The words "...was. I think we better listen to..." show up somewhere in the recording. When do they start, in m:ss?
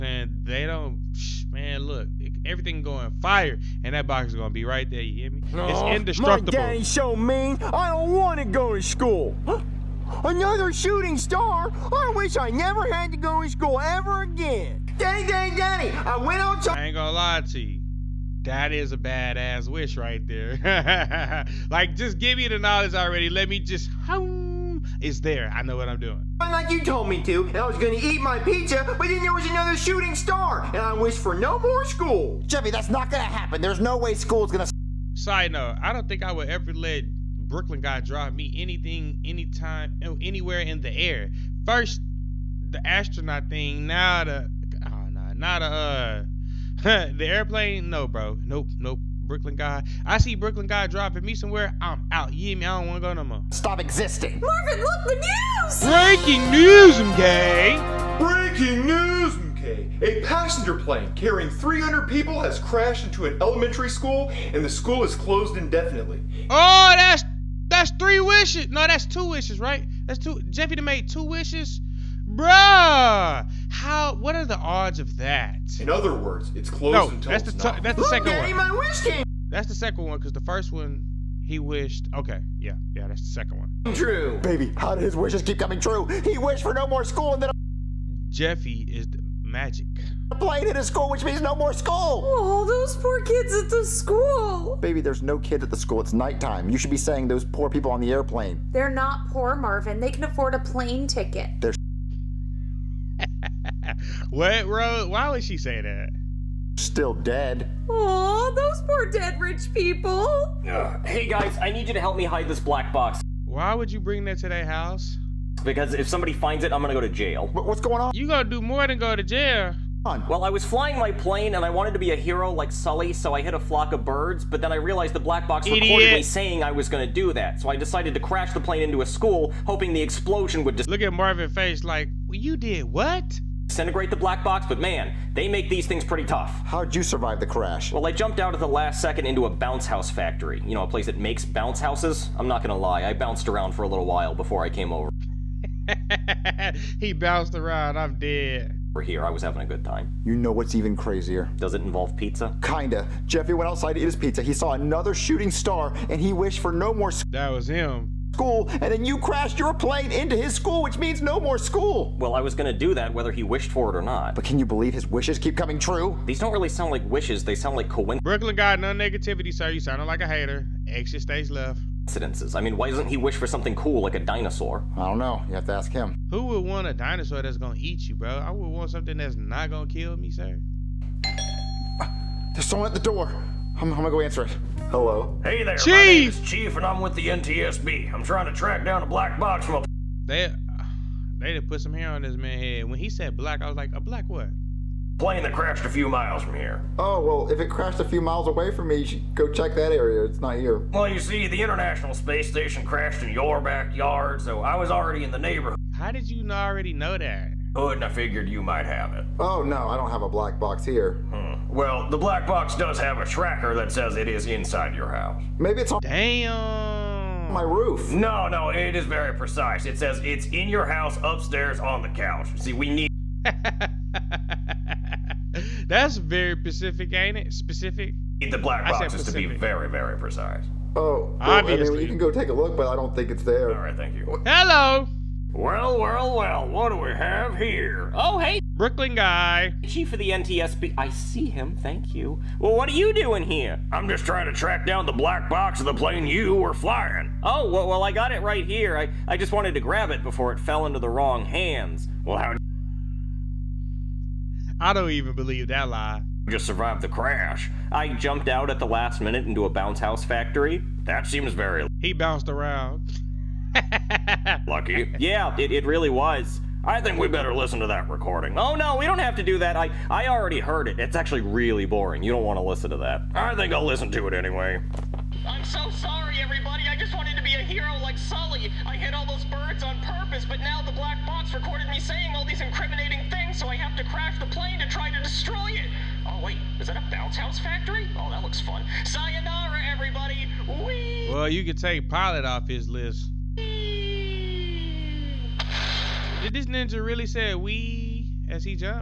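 4:26.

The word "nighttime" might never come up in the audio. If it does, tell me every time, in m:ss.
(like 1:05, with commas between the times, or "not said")
1:36.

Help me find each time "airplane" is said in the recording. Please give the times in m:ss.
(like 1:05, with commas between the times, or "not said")
0:47, 1:38.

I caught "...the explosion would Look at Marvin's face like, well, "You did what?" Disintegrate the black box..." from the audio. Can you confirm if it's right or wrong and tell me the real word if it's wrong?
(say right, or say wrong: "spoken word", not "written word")
right.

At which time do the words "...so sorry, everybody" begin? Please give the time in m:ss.
4:35.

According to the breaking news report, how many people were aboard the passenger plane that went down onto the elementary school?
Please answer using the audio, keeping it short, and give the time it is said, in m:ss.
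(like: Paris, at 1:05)
300, at 1:01.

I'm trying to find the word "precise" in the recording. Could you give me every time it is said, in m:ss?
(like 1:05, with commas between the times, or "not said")
3:39, 3:50.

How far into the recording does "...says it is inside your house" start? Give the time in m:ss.
3:33.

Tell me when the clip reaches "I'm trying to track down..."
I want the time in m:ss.
3:08.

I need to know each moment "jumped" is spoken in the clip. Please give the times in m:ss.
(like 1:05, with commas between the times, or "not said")
2:18, 4:18.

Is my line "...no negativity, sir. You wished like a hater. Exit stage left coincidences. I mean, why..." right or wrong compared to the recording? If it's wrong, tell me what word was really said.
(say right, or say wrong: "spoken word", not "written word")
wrong: "sounded", not "wished".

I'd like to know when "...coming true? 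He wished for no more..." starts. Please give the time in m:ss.
1:25.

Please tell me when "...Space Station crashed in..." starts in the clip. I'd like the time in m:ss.
3:22.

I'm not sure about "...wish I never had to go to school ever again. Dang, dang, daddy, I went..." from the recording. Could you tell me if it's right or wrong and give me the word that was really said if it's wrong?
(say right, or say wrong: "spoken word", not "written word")
right.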